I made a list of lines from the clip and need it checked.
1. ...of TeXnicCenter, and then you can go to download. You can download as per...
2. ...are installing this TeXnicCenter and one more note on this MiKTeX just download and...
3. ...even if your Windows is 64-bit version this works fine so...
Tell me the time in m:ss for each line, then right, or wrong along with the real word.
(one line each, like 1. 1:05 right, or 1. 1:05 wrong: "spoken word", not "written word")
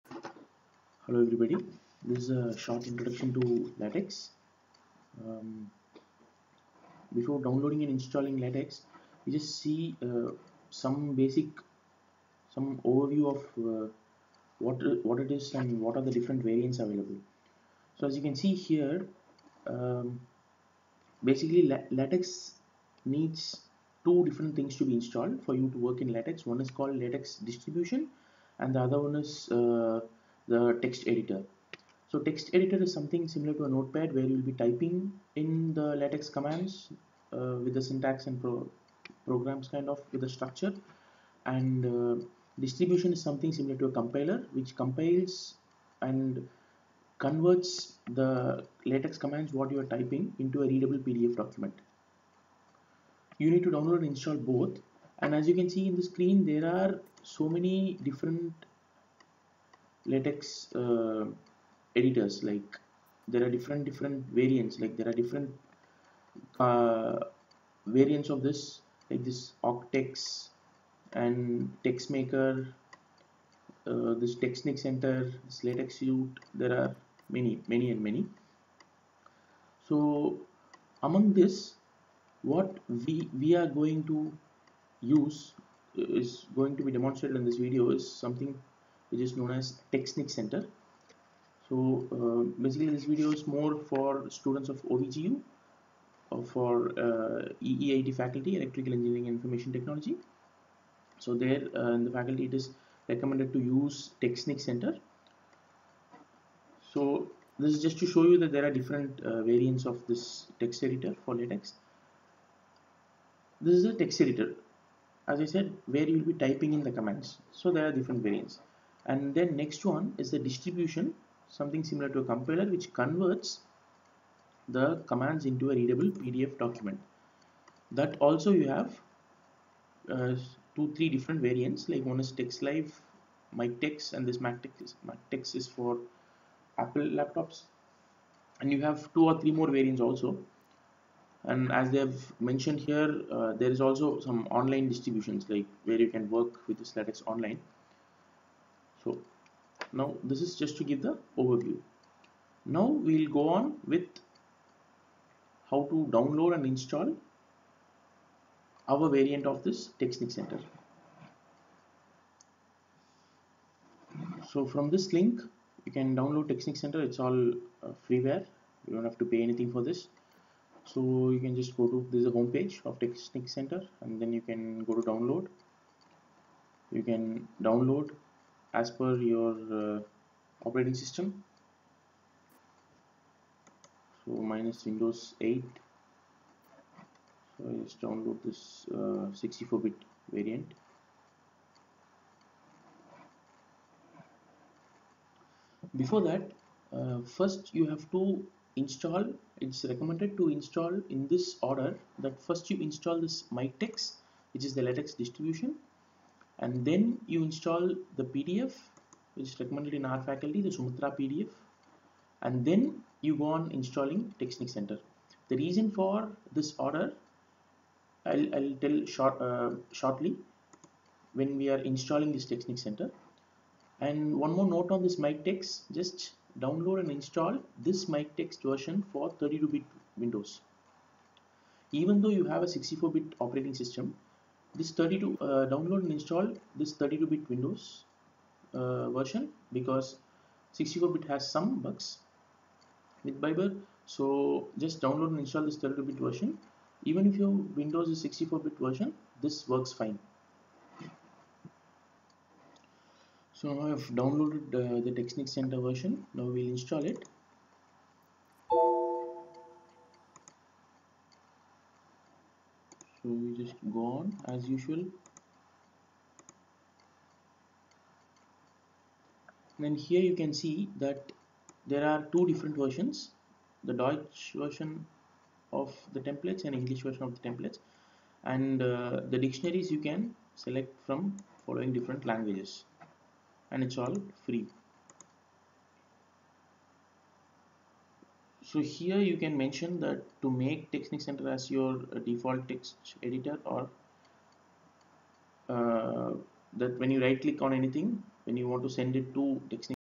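1. 2:52 right
2. 3:41 right
3. 4:07 right.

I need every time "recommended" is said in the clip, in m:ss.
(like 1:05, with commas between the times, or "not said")
1:43, 3:19, 3:29.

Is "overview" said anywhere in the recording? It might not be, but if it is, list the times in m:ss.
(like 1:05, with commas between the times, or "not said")
0:12, 2:31.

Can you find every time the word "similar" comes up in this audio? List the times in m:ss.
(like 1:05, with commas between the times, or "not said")
0:33, 0:43, 2:01.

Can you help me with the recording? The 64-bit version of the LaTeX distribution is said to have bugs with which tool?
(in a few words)
Biber.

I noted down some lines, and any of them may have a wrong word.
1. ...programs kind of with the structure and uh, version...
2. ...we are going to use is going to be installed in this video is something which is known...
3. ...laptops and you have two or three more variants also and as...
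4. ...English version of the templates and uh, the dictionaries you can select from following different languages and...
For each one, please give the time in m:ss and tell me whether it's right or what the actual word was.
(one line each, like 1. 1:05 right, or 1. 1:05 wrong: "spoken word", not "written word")
1. 0:39 wrong: "distribution", not "version"
2. 1:23 wrong: "demonstrated", not "installed"
3. 2:17 right
4. 4:36 right.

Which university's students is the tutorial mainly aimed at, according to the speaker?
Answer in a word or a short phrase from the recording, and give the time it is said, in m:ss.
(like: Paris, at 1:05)
OVGU, at 1:34.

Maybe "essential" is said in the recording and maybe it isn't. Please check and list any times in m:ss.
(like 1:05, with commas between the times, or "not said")
not said.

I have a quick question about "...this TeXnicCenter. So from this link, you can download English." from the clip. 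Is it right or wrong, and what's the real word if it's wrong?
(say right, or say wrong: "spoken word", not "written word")
wrong: "TeXnicCenter", not "English".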